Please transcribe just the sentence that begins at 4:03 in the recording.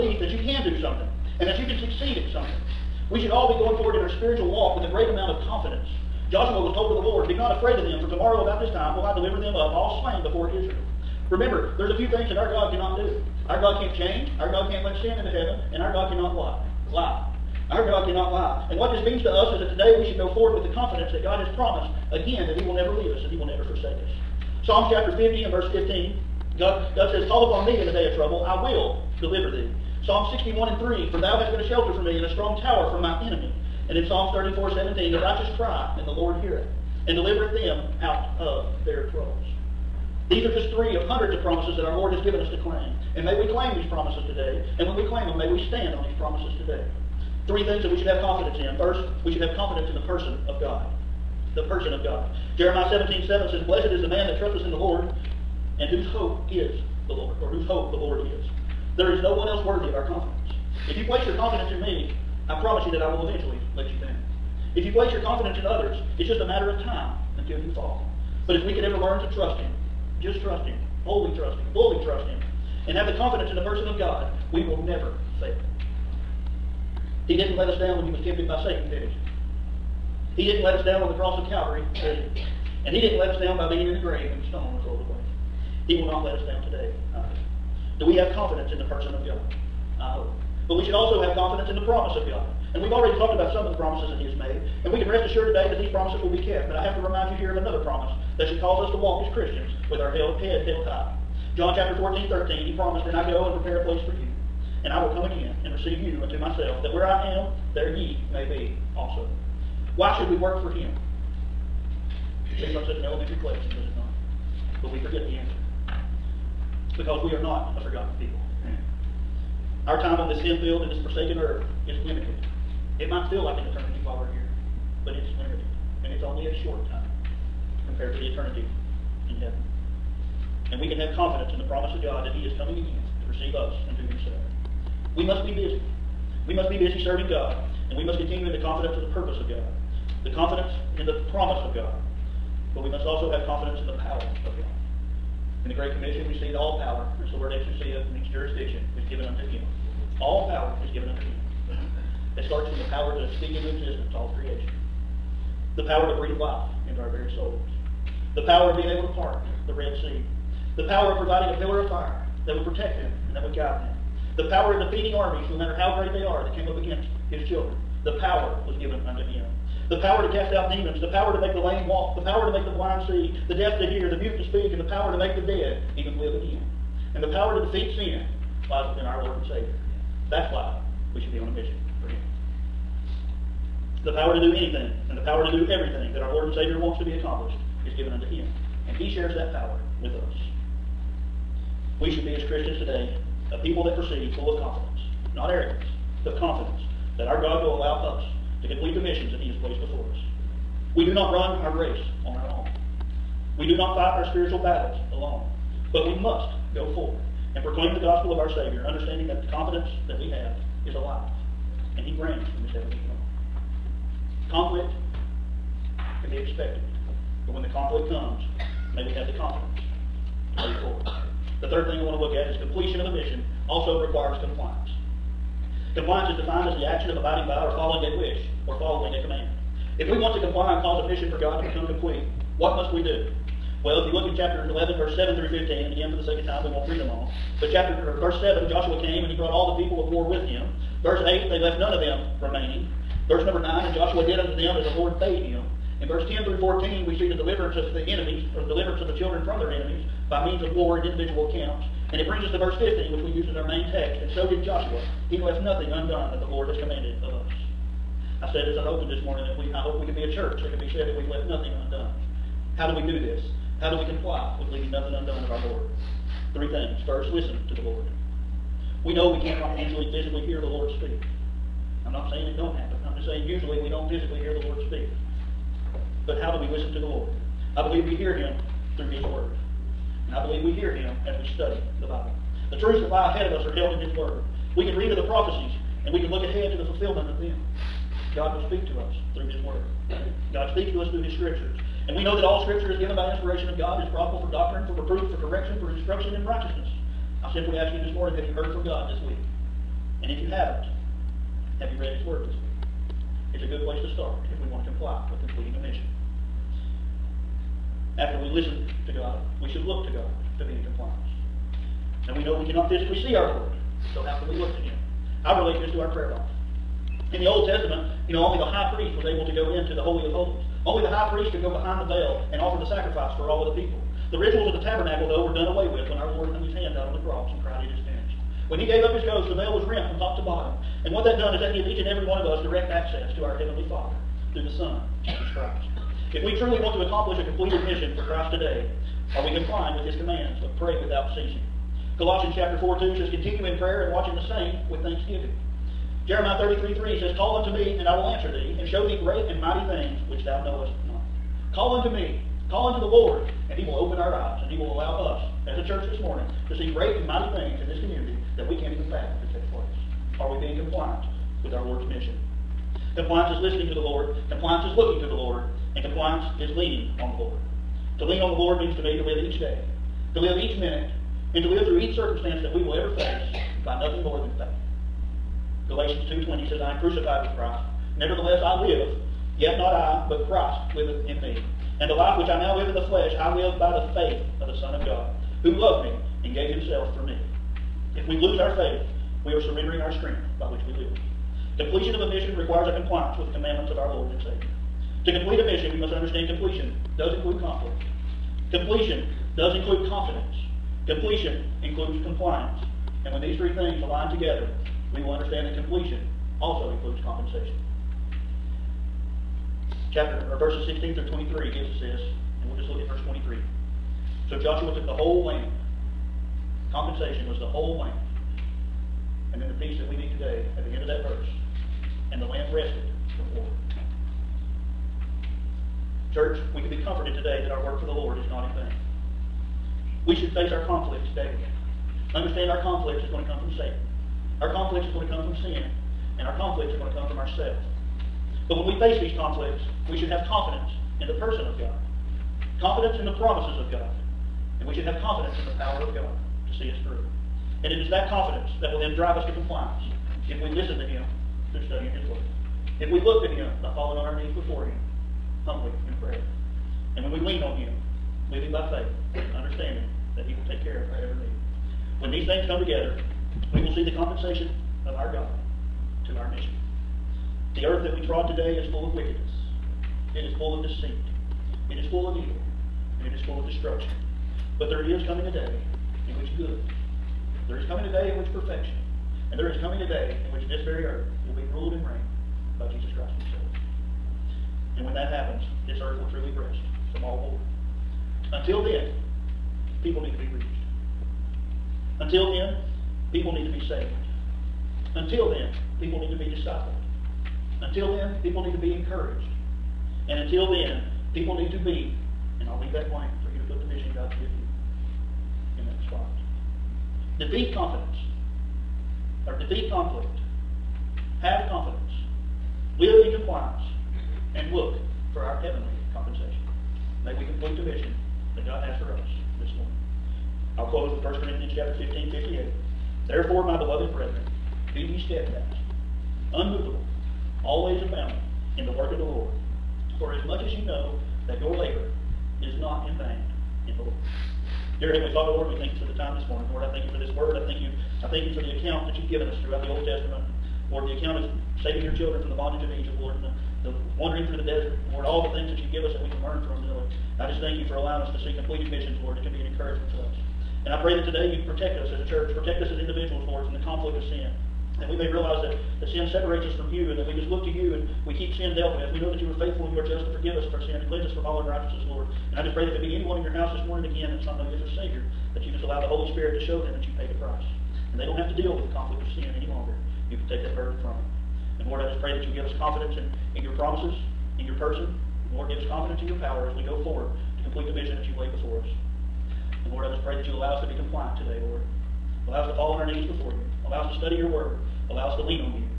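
Verse number 9, And Joshua did unto them as the Lord bade him.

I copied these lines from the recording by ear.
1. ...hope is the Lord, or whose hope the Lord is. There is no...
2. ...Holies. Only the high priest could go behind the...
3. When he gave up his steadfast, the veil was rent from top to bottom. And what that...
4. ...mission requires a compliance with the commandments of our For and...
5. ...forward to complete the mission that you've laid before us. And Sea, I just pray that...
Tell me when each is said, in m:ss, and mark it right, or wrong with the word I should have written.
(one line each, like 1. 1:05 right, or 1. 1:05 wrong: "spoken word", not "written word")
1. 0:56 right
2. 5:20 right
3. 5:28 wrong: "ghost", not "steadfast"
4. 6:32 wrong: "Lord", not "For"
5. 9:37 wrong: "Lord", not "Sea".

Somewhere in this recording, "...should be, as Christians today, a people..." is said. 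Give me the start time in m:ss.
3:12.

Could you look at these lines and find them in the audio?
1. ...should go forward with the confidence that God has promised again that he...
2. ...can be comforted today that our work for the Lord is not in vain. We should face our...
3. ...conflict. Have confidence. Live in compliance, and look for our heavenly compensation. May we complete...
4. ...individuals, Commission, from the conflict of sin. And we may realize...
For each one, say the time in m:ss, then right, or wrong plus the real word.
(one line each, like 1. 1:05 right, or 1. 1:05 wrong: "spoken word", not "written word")
1. 0:20 right
2. 7:06 right
3. 8:29 right
4. 9:12 wrong: "Lord", not "Commission".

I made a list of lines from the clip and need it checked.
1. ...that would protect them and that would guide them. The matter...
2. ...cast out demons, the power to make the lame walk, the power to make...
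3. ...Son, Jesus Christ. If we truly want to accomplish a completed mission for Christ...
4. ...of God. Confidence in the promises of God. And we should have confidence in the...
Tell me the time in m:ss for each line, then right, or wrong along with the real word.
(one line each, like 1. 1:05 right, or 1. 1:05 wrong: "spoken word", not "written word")
1. 2:42 wrong: "power", not "matter"
2. 2:50 right
3. 5:34 right
4. 7:21 right.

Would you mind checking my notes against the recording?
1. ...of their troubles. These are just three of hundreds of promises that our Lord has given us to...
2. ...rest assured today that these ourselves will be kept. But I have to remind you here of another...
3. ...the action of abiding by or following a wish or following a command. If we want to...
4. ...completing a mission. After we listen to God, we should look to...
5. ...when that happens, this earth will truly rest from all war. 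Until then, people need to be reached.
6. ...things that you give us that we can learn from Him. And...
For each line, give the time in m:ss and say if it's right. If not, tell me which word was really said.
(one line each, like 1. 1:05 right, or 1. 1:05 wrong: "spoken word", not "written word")
1. 0:38 right
2. 1:35 wrong: "promises", not "ourselves"
3. 3:46 right
4. 5:05 right
5. 8:05 right
6. 9:05 wrong: "Lord", not "Him".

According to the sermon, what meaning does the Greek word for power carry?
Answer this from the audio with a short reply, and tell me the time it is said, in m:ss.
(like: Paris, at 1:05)
jurisdiction, at 2:28.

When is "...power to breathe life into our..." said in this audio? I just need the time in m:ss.
2:35.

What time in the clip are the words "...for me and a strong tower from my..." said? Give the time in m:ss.
0:31.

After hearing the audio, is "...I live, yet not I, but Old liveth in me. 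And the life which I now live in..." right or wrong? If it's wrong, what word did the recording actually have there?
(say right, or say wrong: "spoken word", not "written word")
wrong: "Christ", not "Old".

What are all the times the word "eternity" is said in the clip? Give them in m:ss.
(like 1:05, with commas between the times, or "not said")
2:03, 2:08.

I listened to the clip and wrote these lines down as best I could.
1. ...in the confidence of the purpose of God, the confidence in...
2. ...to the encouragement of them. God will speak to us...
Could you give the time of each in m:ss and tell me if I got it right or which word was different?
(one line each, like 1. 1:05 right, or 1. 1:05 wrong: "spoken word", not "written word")
1. 2:18 right
2. 4:46 wrong: "fulfillment", not "encouragement".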